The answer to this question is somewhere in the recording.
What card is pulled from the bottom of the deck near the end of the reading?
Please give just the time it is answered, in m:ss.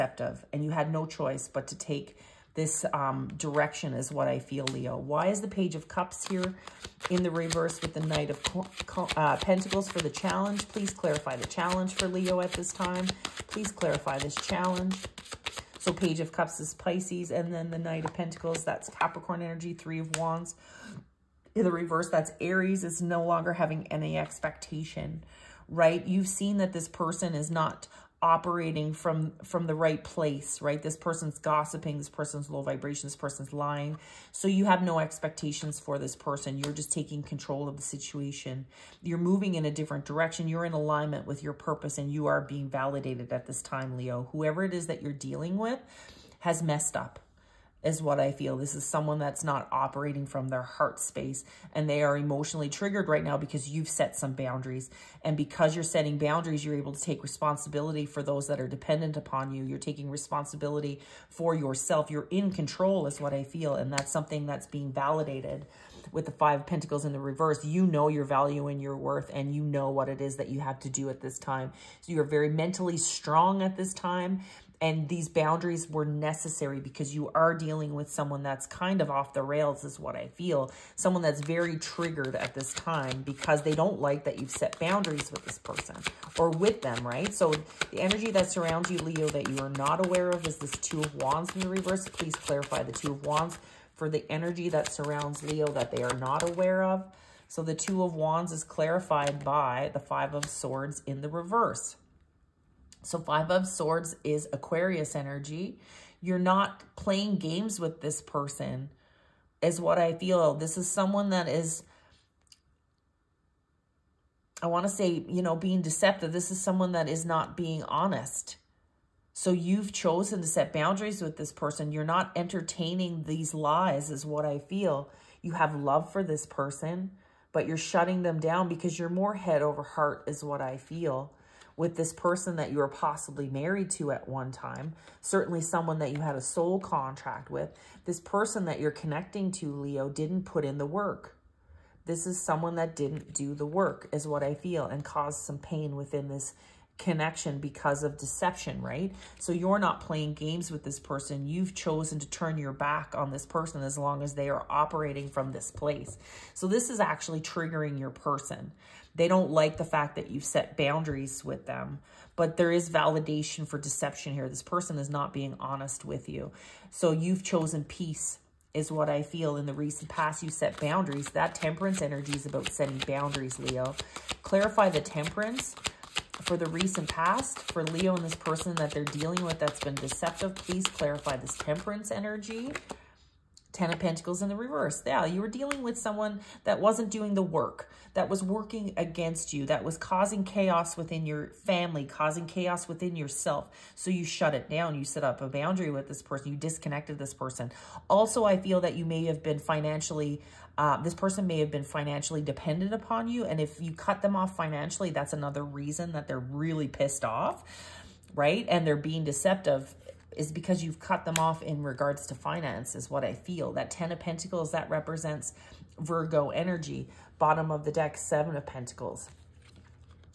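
3:38.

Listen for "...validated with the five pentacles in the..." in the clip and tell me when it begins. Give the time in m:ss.
1:04.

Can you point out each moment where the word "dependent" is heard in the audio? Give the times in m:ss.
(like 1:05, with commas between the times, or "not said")
0:58, 3:22.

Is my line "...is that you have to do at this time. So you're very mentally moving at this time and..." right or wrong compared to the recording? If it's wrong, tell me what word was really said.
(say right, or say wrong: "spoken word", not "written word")
wrong: "strong", not "moving".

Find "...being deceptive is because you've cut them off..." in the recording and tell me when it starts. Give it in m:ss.
3:28.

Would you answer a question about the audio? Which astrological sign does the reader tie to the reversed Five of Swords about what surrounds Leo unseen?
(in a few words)
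Aquarius.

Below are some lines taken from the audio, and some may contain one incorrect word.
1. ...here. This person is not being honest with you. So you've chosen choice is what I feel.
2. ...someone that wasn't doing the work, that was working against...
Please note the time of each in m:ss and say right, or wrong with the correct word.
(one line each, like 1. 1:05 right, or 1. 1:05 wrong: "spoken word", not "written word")
1. 2:44 wrong: "peace", not "choice"
2. 3:05 right.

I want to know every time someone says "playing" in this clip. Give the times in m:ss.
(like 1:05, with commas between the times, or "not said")
1:46, 2:30.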